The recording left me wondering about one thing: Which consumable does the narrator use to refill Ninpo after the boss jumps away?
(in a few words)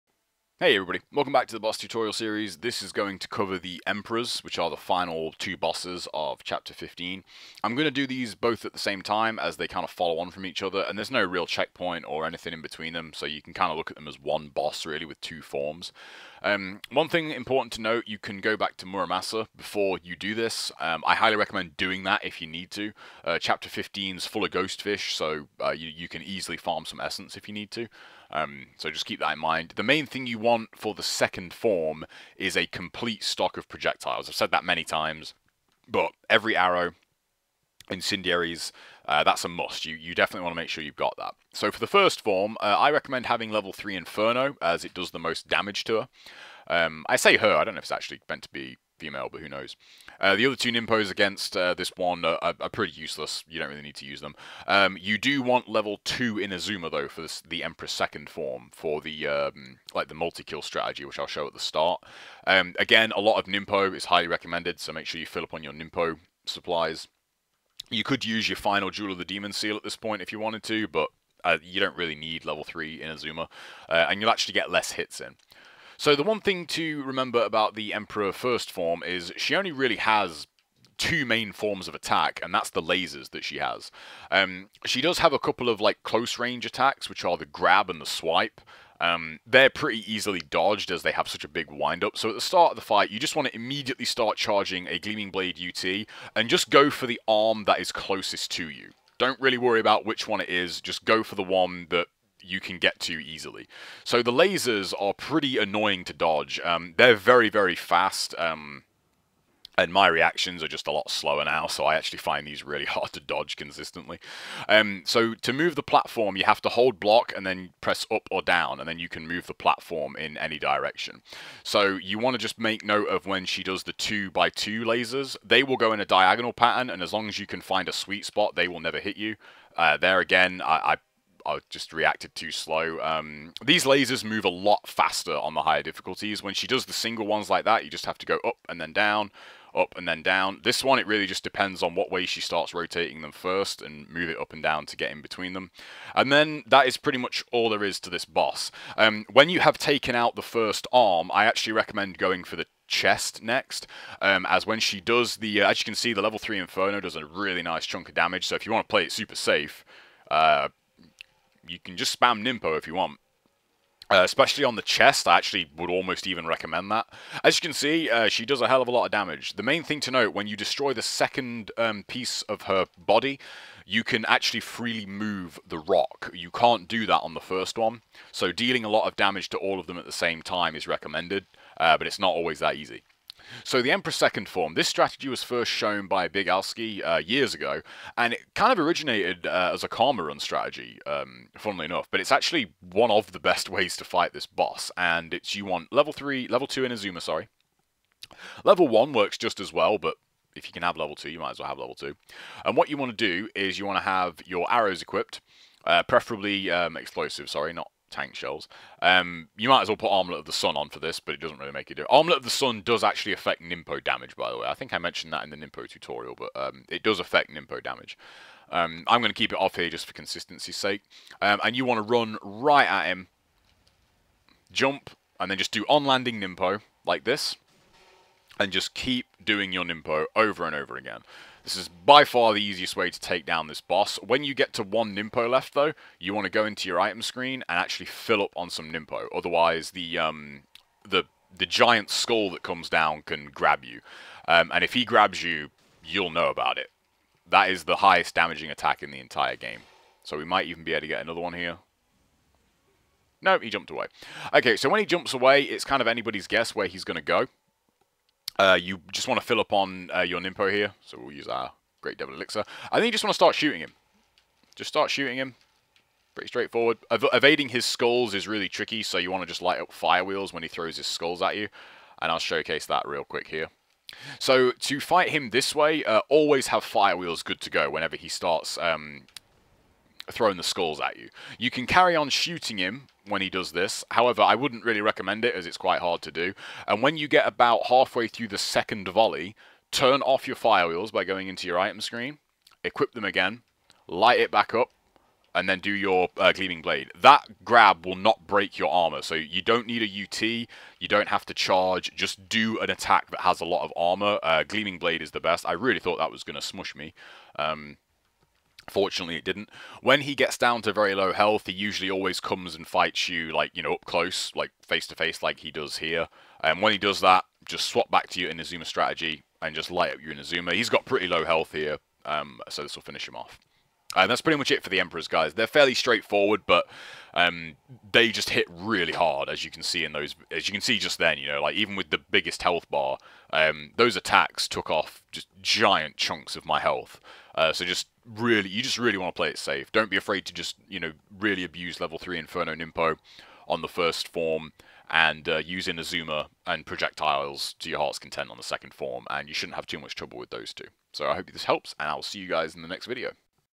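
Great Devil Elixir.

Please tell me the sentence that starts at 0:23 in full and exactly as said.
Uh, chapter 15 is full of ghost fish, so uh, you, you can easily farm some essence if you need to.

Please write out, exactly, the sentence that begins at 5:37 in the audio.
Uh, so just really you just really want to play it safe.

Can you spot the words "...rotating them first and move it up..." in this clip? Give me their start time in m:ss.
2:22.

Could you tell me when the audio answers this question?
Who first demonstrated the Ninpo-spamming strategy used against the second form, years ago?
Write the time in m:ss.
3:06.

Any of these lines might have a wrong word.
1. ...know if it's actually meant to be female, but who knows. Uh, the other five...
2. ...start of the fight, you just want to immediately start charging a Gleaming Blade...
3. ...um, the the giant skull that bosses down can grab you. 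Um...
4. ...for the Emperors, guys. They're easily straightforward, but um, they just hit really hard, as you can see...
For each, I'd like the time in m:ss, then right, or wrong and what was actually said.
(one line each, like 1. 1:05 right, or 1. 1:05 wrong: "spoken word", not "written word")
1. 0:47 wrong: "two", not "five"
2. 1:32 right
3. 4:00 wrong: "comes", not "bosses"
4. 5:24 wrong: "fairly", not "easily".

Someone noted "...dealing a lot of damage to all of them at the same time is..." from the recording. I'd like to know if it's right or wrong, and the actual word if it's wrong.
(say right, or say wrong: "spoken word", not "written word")
right.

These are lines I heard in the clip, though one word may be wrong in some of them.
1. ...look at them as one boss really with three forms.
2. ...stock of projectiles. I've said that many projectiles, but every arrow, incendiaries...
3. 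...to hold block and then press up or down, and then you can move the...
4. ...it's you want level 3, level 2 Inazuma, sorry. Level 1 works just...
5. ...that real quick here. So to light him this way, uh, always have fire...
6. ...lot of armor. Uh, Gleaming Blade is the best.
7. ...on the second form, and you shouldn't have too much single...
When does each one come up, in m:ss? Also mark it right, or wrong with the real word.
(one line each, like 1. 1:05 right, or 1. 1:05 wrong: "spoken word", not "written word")
1. 0:13 wrong: "two", not "three"
2. 0:33 wrong: "times", not "projectiles"
3. 1:56 right
4. 3:15 right
5. 4:32 wrong: "fight", not "light"
6. 5:03 right
7. 5:48 wrong: "trouble", not "single".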